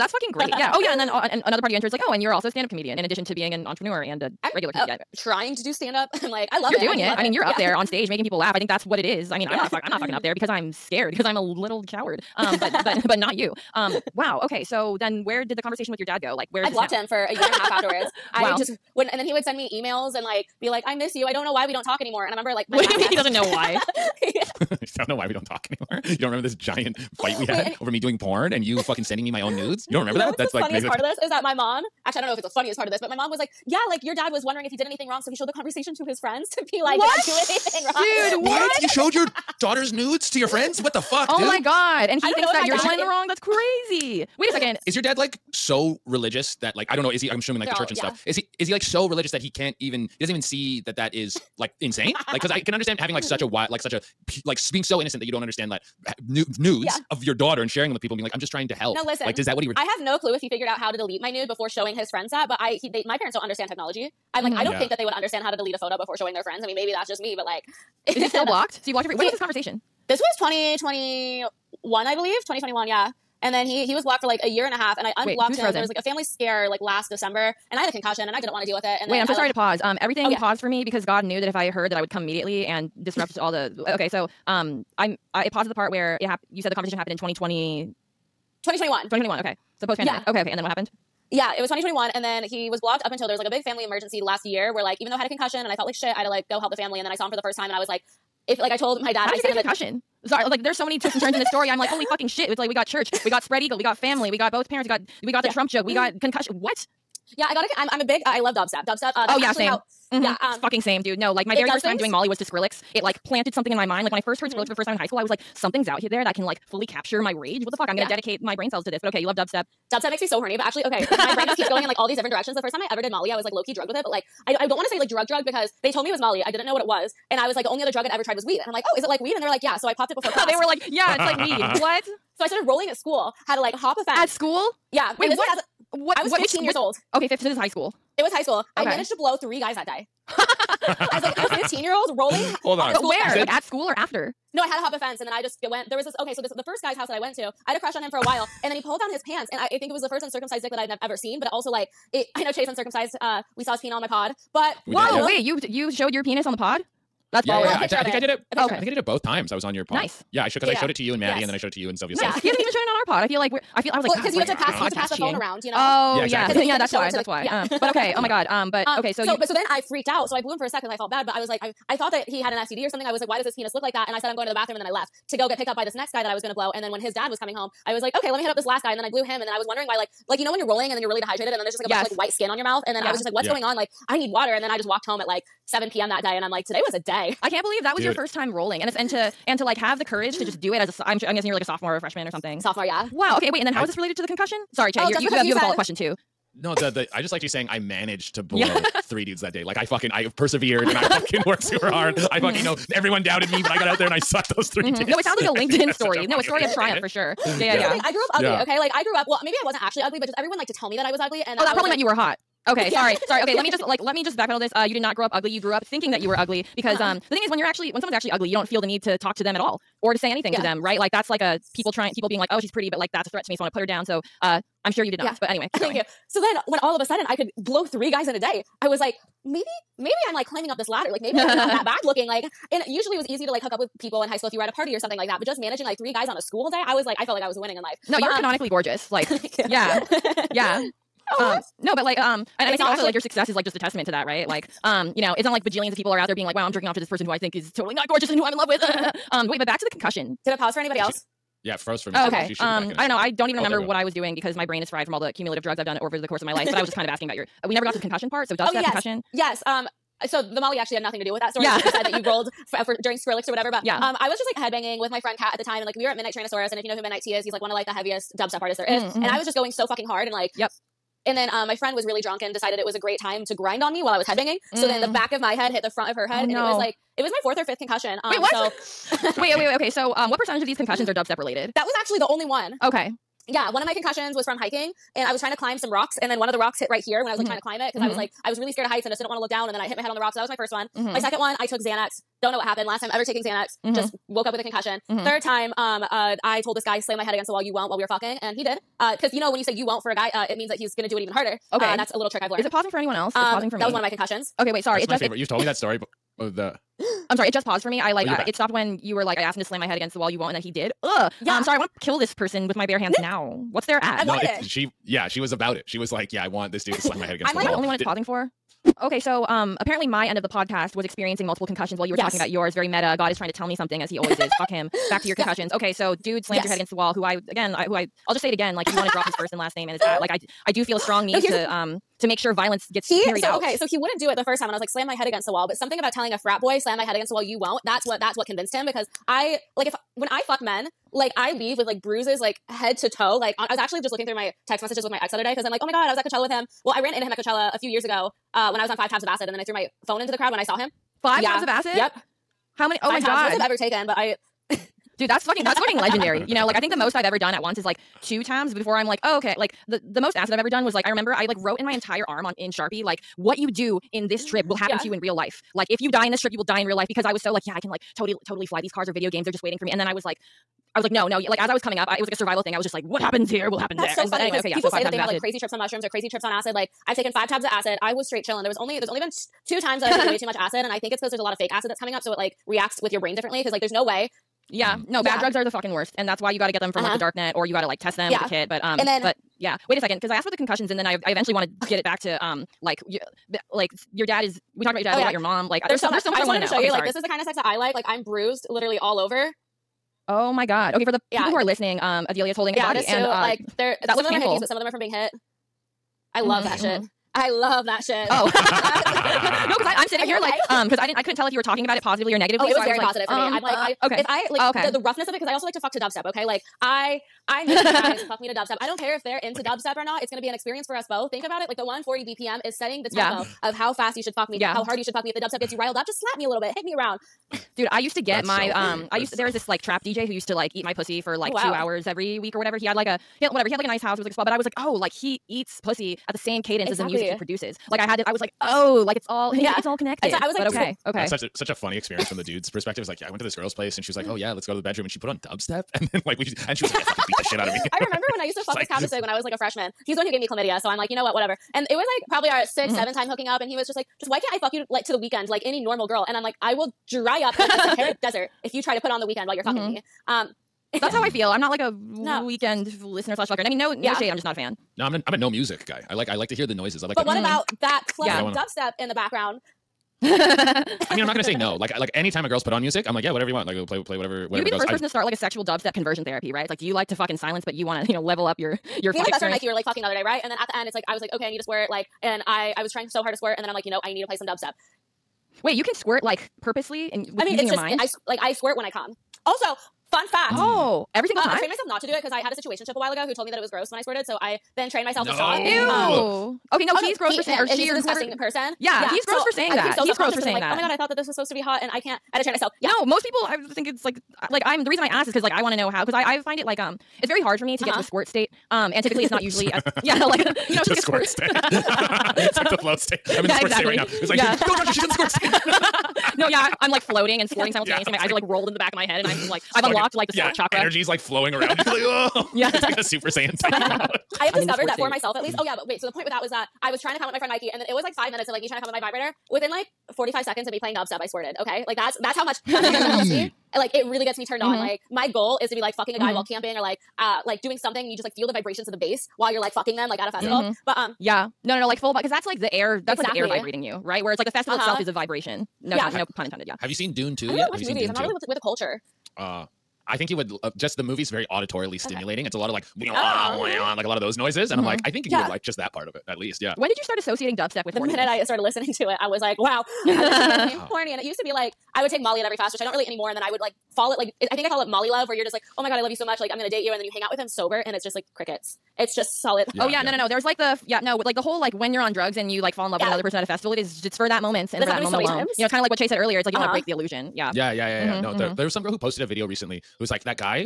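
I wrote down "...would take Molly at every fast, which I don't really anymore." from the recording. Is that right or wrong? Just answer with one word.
right.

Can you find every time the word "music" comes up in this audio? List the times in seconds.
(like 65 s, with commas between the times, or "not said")
437 s, 465 s, 472 s.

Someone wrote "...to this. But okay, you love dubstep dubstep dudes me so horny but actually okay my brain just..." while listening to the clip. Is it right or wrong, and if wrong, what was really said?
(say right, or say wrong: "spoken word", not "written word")
wrong: "makes", not "dudes".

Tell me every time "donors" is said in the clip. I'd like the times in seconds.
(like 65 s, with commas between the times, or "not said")
not said.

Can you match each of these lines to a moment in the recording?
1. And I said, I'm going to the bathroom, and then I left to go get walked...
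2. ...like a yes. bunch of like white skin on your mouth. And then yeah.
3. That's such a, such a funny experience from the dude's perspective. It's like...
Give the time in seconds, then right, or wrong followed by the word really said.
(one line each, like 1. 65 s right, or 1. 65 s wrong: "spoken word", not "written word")
1. 174 s wrong: "picked", not "walked"
2. 181 s right
3. 441 s right.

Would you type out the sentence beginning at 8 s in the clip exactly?
I think that's what it is.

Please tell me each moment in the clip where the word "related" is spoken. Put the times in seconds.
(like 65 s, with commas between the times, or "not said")
193 s, 281 s.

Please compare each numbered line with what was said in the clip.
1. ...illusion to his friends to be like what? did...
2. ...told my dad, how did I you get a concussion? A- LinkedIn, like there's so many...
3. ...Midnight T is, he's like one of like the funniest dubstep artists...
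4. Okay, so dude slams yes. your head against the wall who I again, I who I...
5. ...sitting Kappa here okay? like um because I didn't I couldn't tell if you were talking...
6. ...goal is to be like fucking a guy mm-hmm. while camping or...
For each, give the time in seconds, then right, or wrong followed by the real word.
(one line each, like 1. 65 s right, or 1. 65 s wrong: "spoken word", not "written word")
1. 35 s wrong: "conversation", not "illusion"
2. 98 s wrong: "Sorry", not "LinkedIn"
3. 267 s wrong: "heaviest", not "funniest"
4. 325 s right
5. 410 s wrong: "Are", not "Kappa"
6. 535 s right.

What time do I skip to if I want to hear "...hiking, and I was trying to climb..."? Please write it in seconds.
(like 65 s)
284 s.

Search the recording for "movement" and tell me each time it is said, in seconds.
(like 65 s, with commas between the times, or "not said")
not said.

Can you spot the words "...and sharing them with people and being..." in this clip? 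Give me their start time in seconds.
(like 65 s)
57 s.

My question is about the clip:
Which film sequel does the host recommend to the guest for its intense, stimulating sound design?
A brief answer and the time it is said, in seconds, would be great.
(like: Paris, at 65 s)
Dune 2, at 547 s.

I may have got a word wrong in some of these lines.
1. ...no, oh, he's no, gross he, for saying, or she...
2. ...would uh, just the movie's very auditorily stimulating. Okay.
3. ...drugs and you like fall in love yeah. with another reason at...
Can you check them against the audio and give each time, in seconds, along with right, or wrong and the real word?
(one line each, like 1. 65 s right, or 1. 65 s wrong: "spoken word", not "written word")
1. 496 s right
2. 550 s right
3. 572 s wrong: "person", not "reason".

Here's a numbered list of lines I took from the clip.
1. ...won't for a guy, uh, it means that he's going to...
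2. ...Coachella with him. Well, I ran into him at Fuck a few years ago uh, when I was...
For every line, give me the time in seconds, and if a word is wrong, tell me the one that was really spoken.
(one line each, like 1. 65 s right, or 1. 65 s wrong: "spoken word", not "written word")
1. 299 s right
2. 346 s wrong: "Coachella", not "Fuck".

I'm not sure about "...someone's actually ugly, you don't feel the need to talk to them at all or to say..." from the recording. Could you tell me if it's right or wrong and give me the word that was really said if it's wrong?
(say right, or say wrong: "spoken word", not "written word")
right.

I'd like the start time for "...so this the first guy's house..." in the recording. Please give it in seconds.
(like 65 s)
146 s.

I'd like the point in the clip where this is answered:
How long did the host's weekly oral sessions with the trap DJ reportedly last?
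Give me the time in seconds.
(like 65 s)
431 s.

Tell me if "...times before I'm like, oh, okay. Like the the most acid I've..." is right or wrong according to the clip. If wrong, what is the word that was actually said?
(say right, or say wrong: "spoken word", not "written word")
right.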